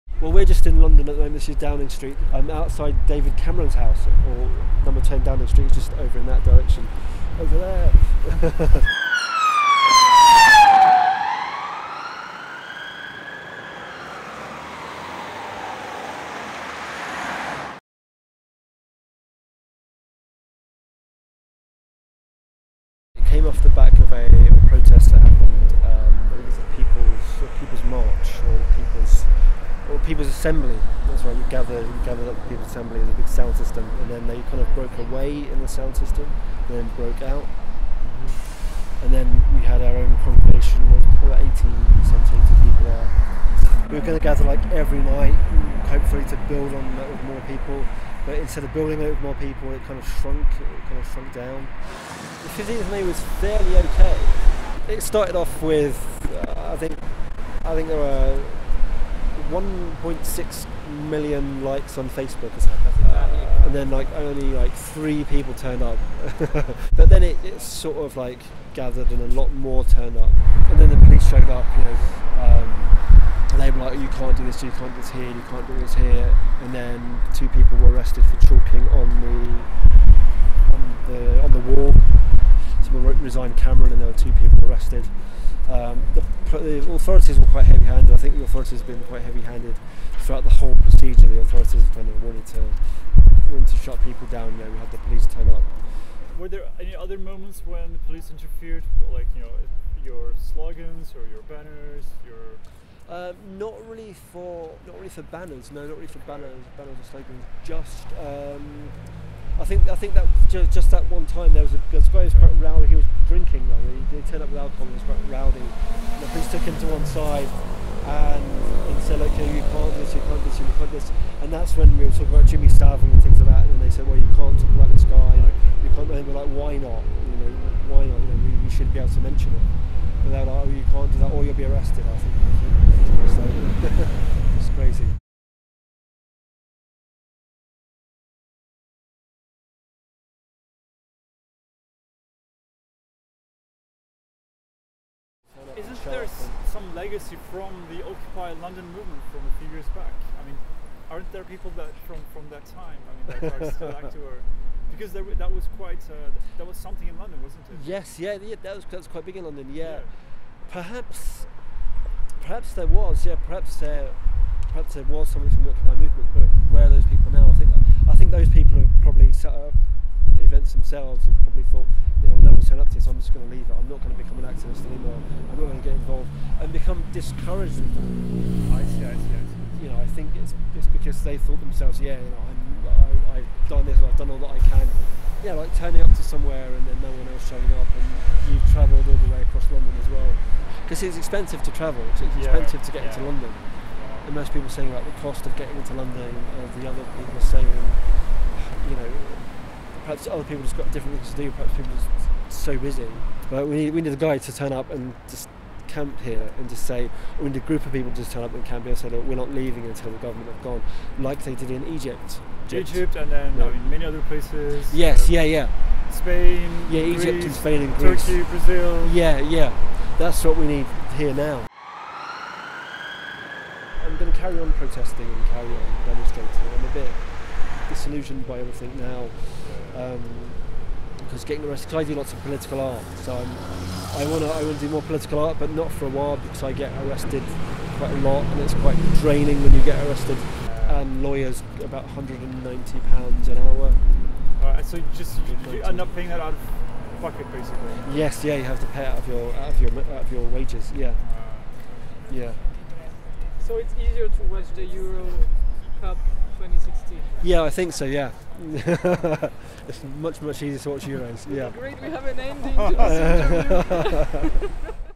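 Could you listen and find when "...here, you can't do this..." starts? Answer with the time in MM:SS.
01:15.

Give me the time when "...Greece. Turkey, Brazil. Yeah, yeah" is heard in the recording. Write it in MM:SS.
03:37.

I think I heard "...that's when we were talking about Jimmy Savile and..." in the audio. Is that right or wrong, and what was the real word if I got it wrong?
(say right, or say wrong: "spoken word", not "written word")
right.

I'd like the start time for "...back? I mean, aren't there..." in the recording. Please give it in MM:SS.
02:29.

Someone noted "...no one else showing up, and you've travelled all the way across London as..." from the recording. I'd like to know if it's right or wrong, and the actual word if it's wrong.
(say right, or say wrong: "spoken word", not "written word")
right.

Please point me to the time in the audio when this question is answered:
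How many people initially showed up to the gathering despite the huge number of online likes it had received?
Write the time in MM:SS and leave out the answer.
01:04.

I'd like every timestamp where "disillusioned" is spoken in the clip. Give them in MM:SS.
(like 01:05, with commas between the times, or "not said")
03:47.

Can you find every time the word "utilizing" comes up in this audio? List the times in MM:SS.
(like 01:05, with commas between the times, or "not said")
not said.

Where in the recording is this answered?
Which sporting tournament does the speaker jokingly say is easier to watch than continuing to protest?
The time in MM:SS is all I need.
04:14.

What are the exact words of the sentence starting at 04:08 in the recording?
Yes, yeah, you have to pay out of your out of your out of your wages.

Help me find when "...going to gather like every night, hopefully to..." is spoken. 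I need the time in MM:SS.
00:44.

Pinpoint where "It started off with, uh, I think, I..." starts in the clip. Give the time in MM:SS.
00:54.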